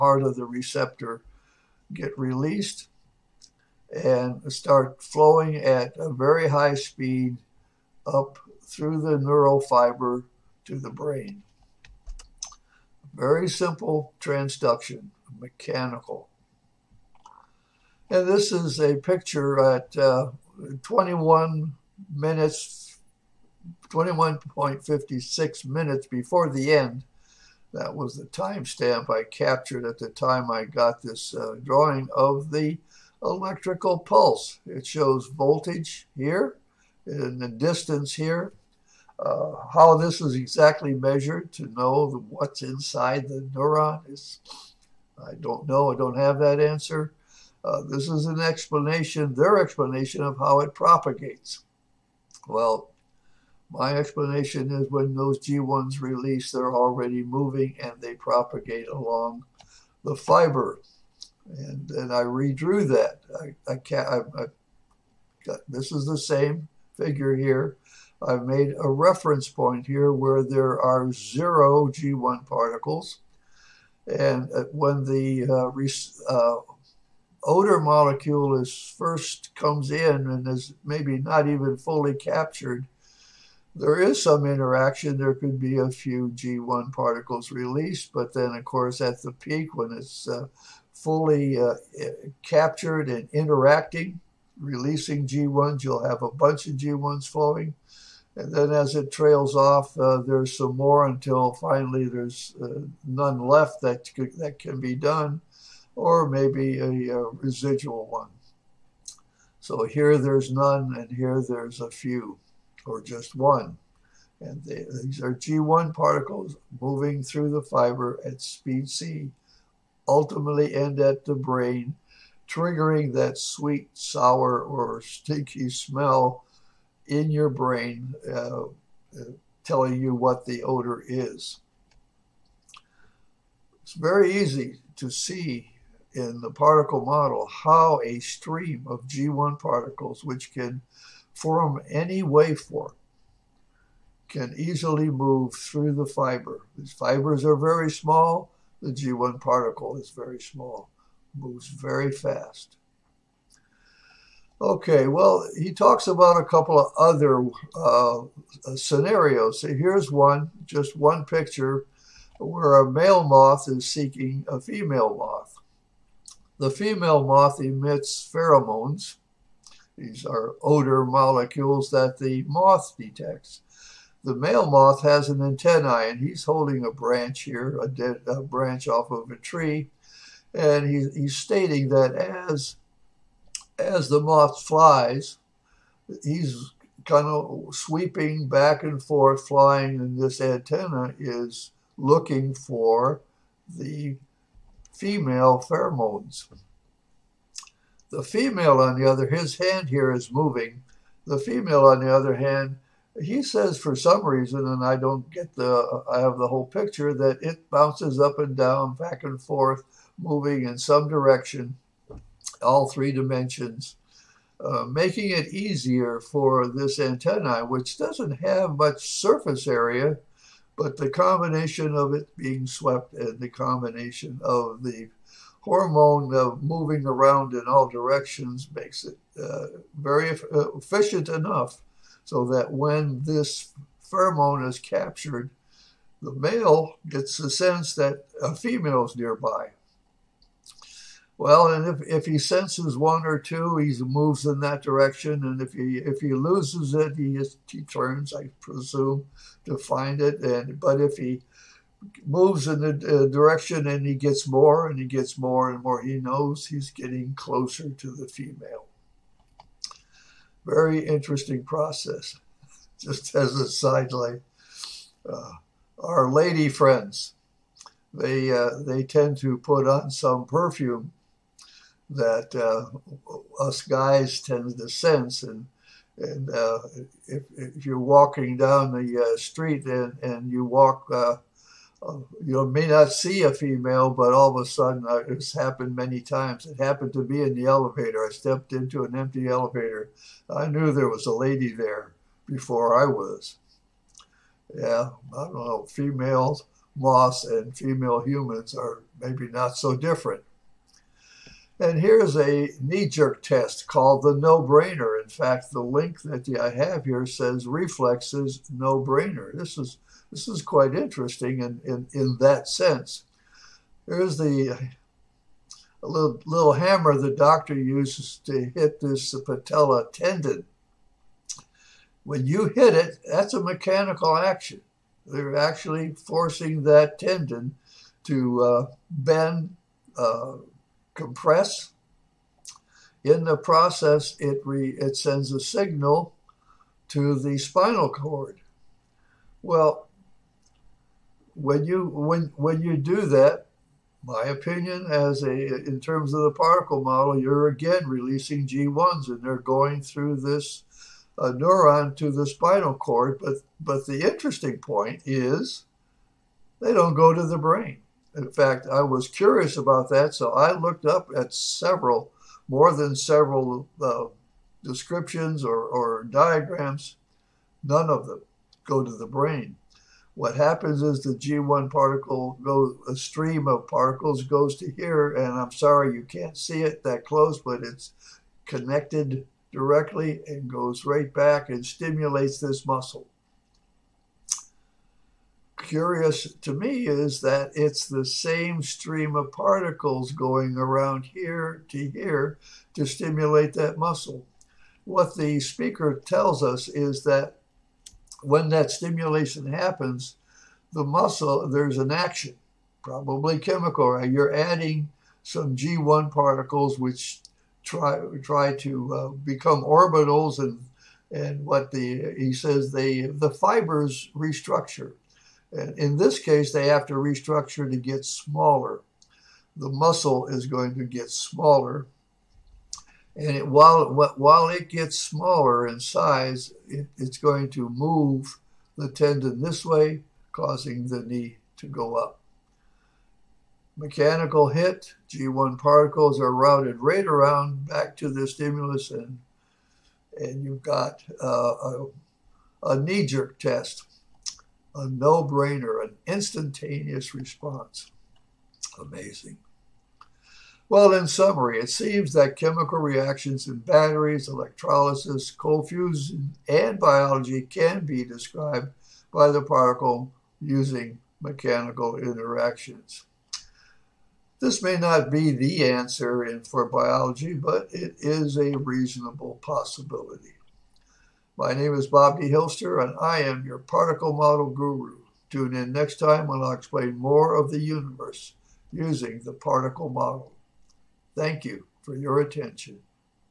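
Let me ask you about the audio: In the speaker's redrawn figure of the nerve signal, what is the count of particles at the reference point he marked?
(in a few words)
zero.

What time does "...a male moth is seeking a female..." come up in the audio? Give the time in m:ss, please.
2:42.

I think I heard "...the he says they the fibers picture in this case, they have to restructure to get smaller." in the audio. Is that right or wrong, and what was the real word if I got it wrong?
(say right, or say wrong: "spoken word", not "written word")
wrong: "restructure", not "picture".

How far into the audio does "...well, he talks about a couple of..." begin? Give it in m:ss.
2:35.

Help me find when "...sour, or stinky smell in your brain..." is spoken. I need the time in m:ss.
2:03.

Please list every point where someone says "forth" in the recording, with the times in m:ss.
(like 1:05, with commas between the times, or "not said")
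3:09, 3:29.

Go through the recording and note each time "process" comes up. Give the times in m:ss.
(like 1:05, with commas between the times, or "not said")
4:21, 5:33.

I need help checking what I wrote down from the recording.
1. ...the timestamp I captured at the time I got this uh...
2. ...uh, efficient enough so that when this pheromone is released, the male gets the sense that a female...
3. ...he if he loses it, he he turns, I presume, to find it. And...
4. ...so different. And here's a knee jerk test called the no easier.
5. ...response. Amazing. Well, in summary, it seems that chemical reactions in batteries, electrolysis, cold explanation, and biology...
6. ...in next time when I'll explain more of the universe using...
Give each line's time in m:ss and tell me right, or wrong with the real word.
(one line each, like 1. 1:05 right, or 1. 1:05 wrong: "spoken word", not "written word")
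1. 0:28 right
2. 3:50 wrong: "captured", not "released"
3. 4:05 right
4. 4:59 wrong: "brainer", not "easier"
5. 7:27 wrong: "fusion", not "explanation"
6. 7:55 right.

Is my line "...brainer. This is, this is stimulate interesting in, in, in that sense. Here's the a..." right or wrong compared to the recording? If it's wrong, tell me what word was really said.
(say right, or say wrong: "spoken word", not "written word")
wrong: "quite", not "stimulate".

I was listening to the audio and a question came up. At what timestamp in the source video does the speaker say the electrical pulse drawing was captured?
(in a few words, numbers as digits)
21.56.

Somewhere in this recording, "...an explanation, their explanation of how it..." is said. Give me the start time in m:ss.
0:48.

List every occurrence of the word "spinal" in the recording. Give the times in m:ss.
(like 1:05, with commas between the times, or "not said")
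5:37, 5:52.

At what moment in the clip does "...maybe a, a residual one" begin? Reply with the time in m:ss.
1:46.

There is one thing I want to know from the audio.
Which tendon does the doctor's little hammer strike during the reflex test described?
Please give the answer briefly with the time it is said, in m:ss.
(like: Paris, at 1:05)
patella tendon, at 5:19.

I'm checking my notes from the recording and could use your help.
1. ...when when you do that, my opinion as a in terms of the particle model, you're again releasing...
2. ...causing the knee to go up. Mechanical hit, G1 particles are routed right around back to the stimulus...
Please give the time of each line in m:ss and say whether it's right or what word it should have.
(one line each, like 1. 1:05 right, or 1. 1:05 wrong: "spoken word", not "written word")
1. 5:42 right
2. 7:10 right.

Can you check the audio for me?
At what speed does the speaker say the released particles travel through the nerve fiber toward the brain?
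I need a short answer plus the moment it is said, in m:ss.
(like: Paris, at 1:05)
speed C, at 1:58.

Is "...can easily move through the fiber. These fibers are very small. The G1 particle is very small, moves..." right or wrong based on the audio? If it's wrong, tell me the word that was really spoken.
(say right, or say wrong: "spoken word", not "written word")
right.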